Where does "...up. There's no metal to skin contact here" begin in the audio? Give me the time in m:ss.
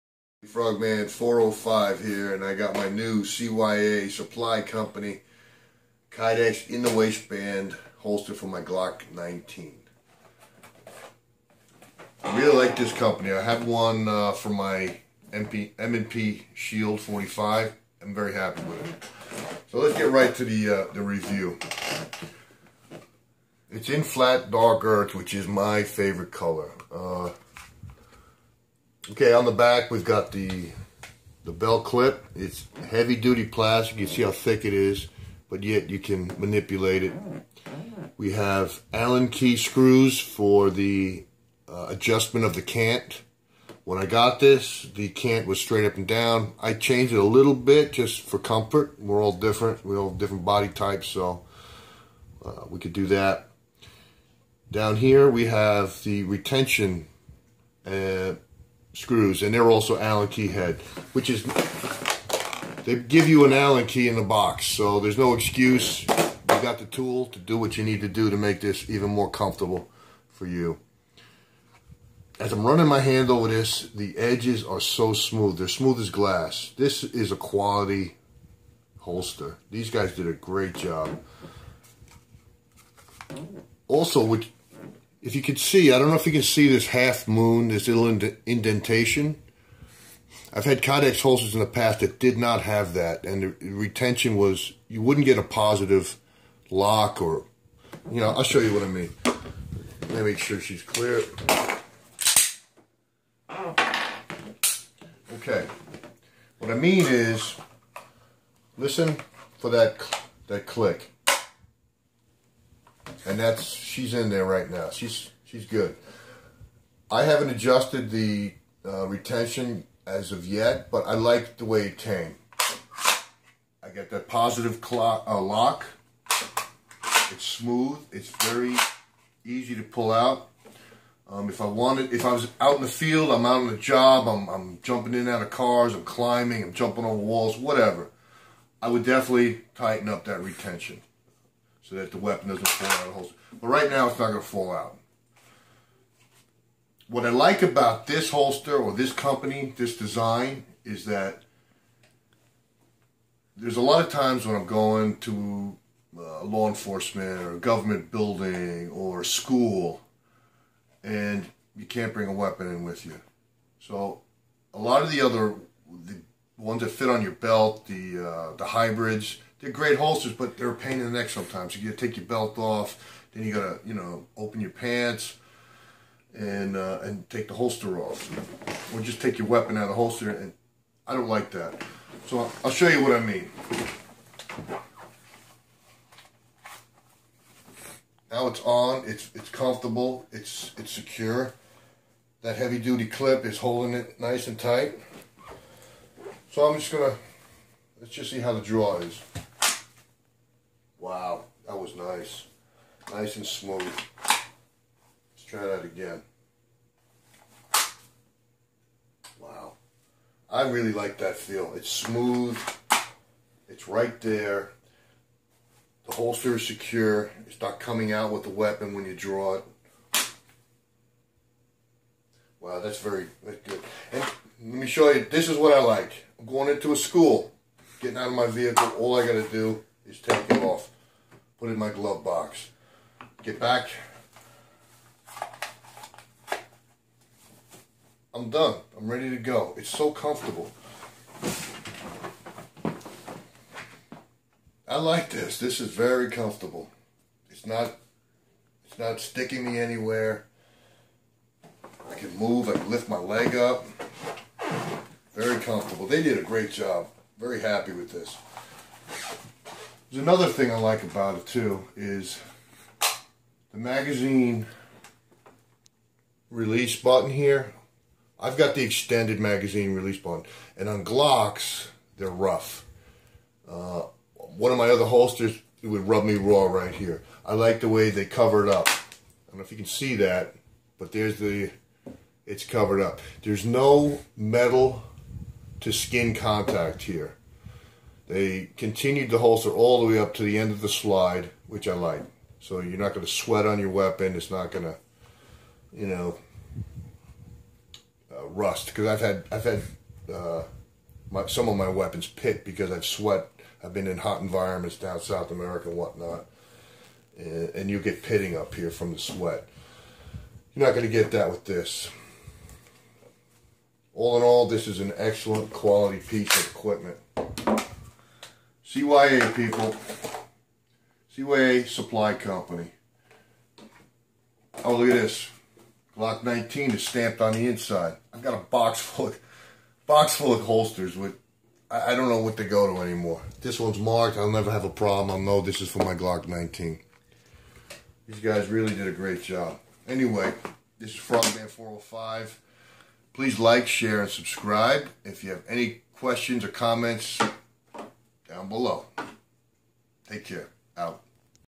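4:42.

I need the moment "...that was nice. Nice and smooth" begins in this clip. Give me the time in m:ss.
3:21.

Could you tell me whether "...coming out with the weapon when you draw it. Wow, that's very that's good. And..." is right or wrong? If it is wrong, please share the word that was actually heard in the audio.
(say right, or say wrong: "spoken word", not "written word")
right.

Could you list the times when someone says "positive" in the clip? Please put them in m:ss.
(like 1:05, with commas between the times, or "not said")
1:35, 2:04.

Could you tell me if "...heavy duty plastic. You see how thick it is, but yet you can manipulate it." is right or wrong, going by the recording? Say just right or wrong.
right.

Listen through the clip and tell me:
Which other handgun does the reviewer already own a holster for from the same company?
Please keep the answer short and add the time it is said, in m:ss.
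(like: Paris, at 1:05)
M&P Shield 45, at 0:15.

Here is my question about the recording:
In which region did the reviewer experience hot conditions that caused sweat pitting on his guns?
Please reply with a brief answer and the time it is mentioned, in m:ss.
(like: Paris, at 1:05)
South America, at 5:05.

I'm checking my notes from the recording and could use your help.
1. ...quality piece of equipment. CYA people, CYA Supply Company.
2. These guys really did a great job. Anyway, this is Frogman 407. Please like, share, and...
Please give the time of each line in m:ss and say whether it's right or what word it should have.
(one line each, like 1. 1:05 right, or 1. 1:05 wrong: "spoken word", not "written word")
1. 5:15 right
2. 5:38 wrong: "405", not "407".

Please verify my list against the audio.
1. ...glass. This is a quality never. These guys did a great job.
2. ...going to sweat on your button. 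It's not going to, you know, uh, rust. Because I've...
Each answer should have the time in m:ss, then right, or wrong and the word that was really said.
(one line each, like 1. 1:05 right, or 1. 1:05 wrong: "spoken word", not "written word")
1. 1:16 wrong: "holster", not "never"
2. 4:53 wrong: "weapon", not "button".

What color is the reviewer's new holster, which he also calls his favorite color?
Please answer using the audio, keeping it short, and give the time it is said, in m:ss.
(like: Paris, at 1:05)
flat dark earth, at 0:24.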